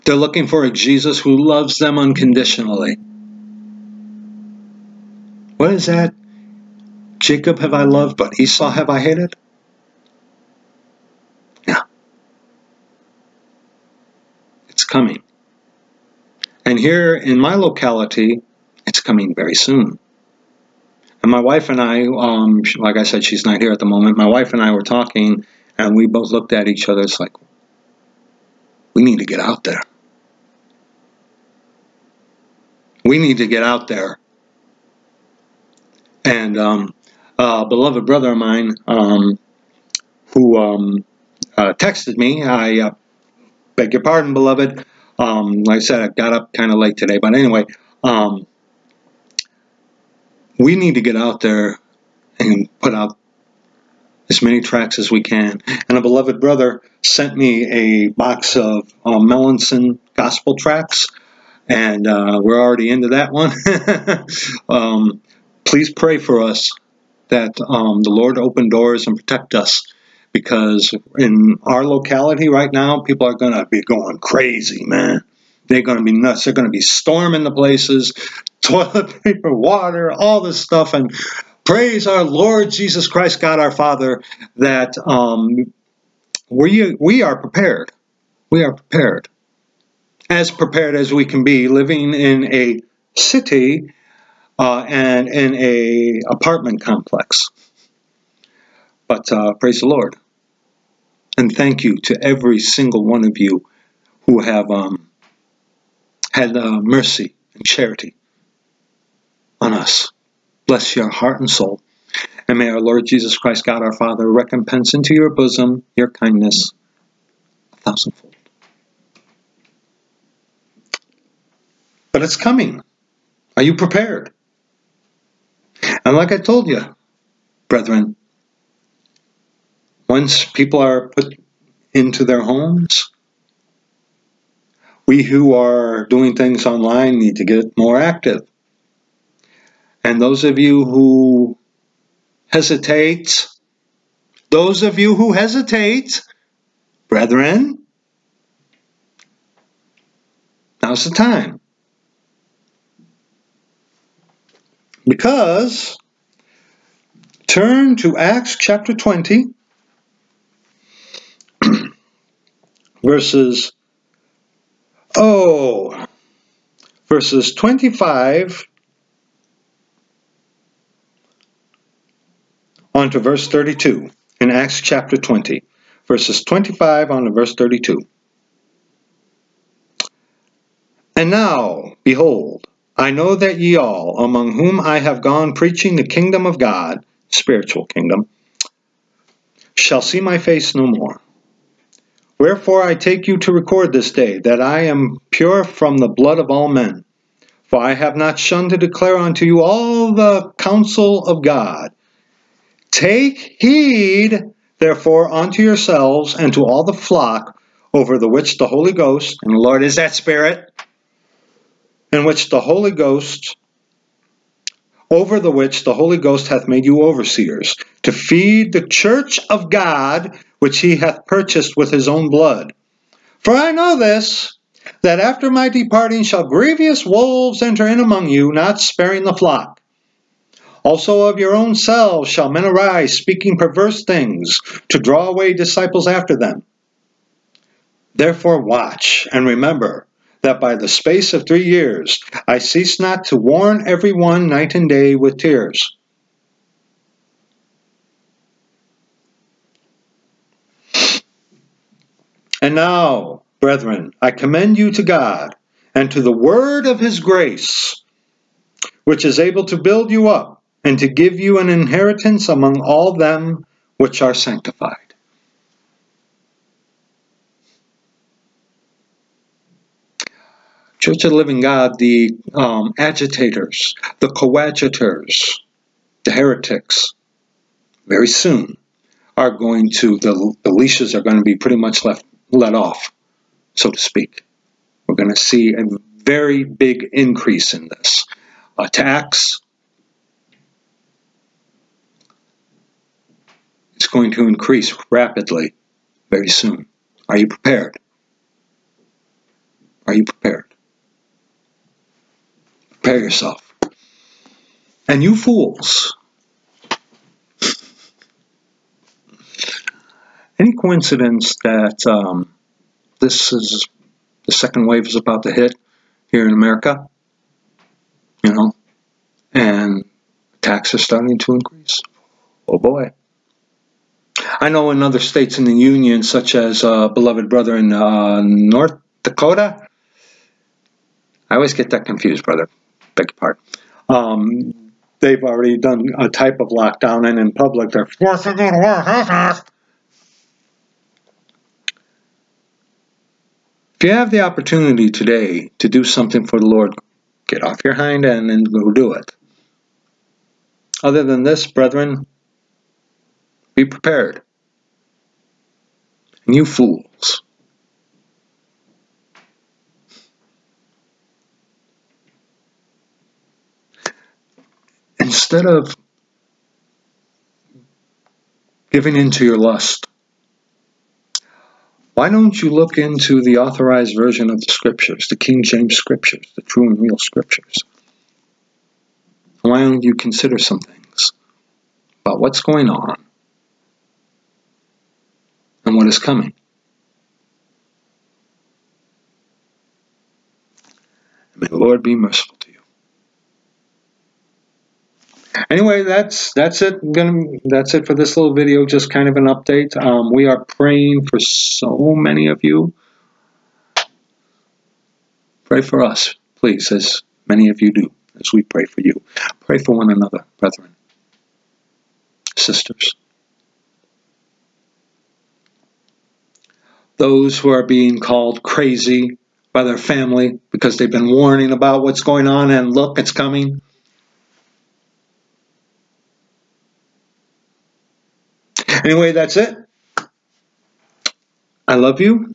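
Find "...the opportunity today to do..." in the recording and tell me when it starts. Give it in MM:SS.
05:44.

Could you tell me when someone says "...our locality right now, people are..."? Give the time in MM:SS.
01:11.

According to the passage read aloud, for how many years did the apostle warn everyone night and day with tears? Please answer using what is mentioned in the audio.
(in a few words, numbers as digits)
3.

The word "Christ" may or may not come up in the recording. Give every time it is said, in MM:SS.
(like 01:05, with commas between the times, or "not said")
01:23, 01:53.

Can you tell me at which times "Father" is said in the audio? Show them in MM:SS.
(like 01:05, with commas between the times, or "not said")
01:23, 01:53.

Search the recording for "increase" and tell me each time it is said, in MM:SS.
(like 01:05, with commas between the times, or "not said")
04:47, 04:54, 05:21.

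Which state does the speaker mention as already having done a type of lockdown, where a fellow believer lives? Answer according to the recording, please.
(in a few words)
North Dakota.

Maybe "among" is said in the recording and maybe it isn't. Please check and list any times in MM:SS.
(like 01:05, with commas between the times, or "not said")
03:04, 03:47, 04:22.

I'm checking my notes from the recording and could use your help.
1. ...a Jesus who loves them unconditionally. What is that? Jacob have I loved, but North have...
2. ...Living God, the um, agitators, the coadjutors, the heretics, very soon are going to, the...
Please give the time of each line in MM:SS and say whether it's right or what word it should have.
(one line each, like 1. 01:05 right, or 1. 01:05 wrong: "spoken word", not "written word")
1. 00:00 wrong: "Esau", not "North"
2. 04:31 right.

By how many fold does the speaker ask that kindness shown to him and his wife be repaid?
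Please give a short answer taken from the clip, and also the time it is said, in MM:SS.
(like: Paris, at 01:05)
a thousandfold, at 01:57.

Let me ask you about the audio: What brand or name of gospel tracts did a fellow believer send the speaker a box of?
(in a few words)
Melanson.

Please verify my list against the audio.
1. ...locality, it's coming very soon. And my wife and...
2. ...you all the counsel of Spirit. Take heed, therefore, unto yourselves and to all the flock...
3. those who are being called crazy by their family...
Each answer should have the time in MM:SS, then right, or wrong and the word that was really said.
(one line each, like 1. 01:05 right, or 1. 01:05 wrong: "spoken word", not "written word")
1. 00:17 right
2. 03:19 wrong: "God", not "Spirit"
3. 06:57 right.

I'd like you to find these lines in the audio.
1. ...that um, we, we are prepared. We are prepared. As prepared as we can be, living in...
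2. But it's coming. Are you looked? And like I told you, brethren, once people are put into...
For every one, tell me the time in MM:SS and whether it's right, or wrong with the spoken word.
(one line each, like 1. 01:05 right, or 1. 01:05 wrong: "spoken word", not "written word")
1. 01:24 right
2. 02:02 wrong: "prepared", not "looked".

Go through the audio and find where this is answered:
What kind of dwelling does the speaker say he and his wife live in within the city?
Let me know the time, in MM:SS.
01:36.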